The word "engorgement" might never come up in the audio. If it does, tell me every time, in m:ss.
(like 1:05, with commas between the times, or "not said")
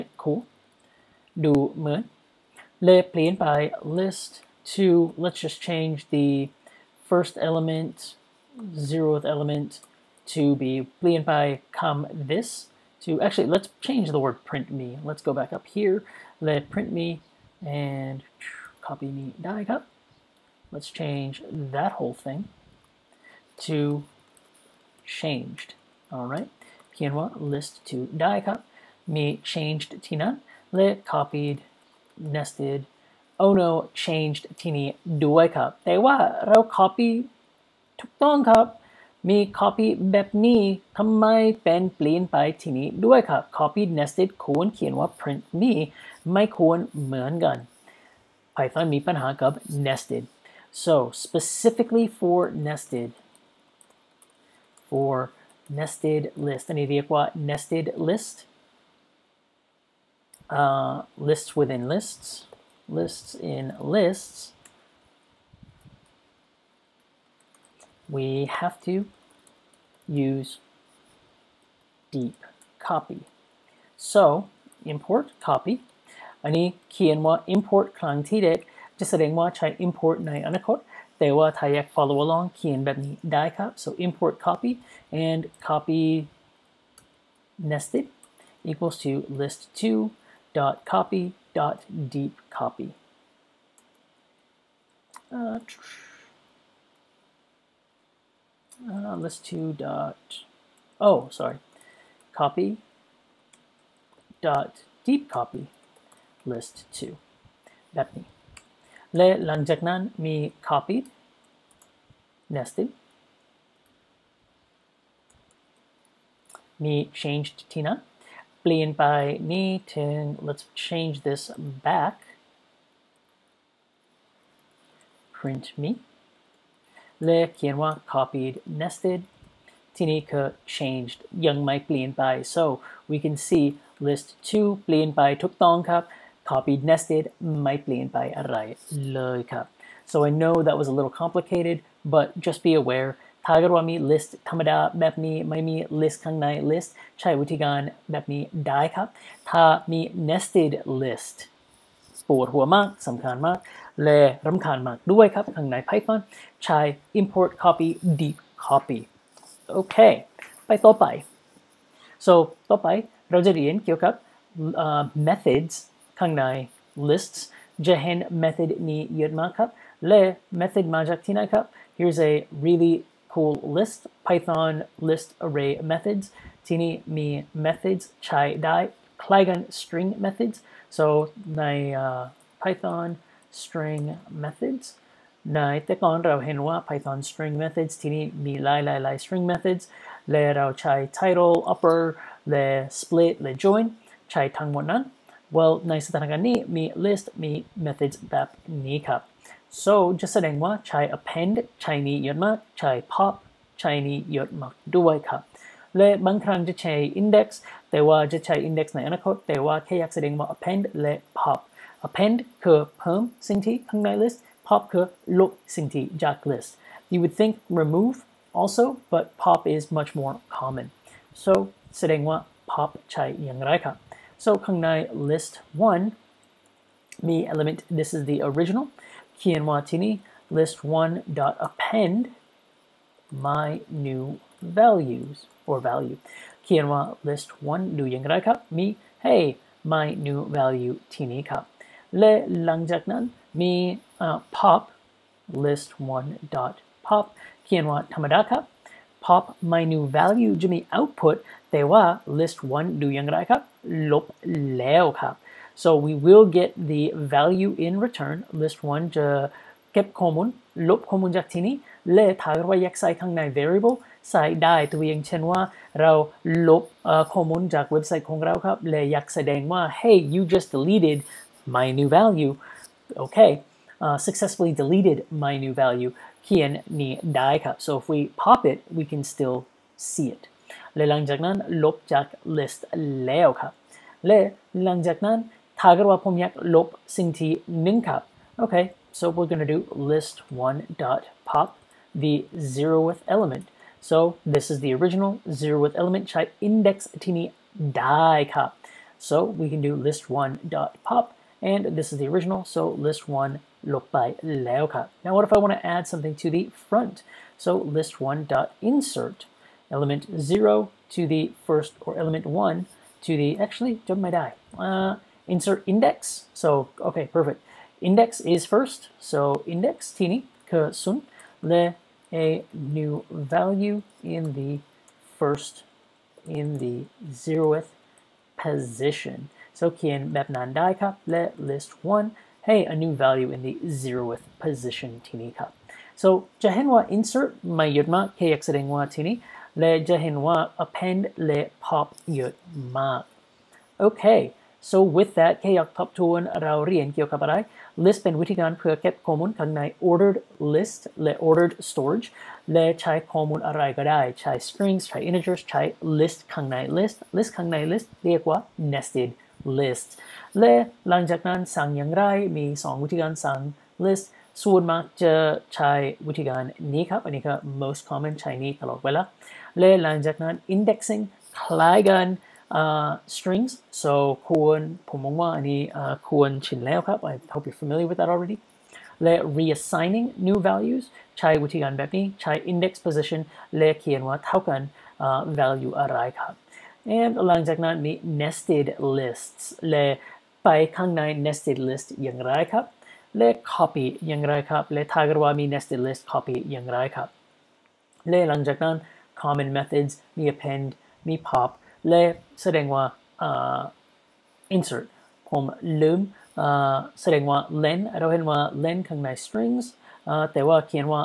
not said.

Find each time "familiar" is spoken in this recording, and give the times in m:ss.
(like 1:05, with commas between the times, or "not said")
6:17.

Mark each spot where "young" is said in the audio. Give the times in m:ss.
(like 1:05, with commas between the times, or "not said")
2:11.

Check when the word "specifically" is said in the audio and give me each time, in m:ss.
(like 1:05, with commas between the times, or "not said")
0:51.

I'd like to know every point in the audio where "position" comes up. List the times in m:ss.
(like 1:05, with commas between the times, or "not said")
5:28, 5:34, 6:23.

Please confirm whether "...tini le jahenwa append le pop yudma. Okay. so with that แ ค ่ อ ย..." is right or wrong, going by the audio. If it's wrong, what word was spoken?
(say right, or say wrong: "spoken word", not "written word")
right.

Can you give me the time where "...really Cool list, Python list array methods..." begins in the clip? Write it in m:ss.
2:52.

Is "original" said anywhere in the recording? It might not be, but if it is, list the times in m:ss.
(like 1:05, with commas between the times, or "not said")
3:48, 4:54, 5:02.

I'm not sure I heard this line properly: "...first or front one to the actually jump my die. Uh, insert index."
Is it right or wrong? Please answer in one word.
wrong.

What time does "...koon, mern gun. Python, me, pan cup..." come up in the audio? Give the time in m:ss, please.
0:46.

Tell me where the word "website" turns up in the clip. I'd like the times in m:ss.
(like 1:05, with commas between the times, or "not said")
4:27.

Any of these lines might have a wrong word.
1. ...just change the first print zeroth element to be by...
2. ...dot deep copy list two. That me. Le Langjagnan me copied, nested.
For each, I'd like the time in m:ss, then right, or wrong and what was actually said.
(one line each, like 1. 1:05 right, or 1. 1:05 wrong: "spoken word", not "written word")
1. 0:05 wrong: "element", not "print"
2. 1:44 right.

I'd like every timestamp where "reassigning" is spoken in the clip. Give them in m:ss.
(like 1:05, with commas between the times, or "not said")
6:19.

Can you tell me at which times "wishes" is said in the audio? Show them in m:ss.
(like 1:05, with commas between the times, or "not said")
not said.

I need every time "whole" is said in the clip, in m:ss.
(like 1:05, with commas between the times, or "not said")
0:21.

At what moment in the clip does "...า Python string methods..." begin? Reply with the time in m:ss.
3:06.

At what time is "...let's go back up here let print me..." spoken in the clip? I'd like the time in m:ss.
0:15.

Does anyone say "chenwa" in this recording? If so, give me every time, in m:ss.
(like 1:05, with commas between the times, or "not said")
4:25.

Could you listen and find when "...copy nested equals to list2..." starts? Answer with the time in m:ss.
1:25.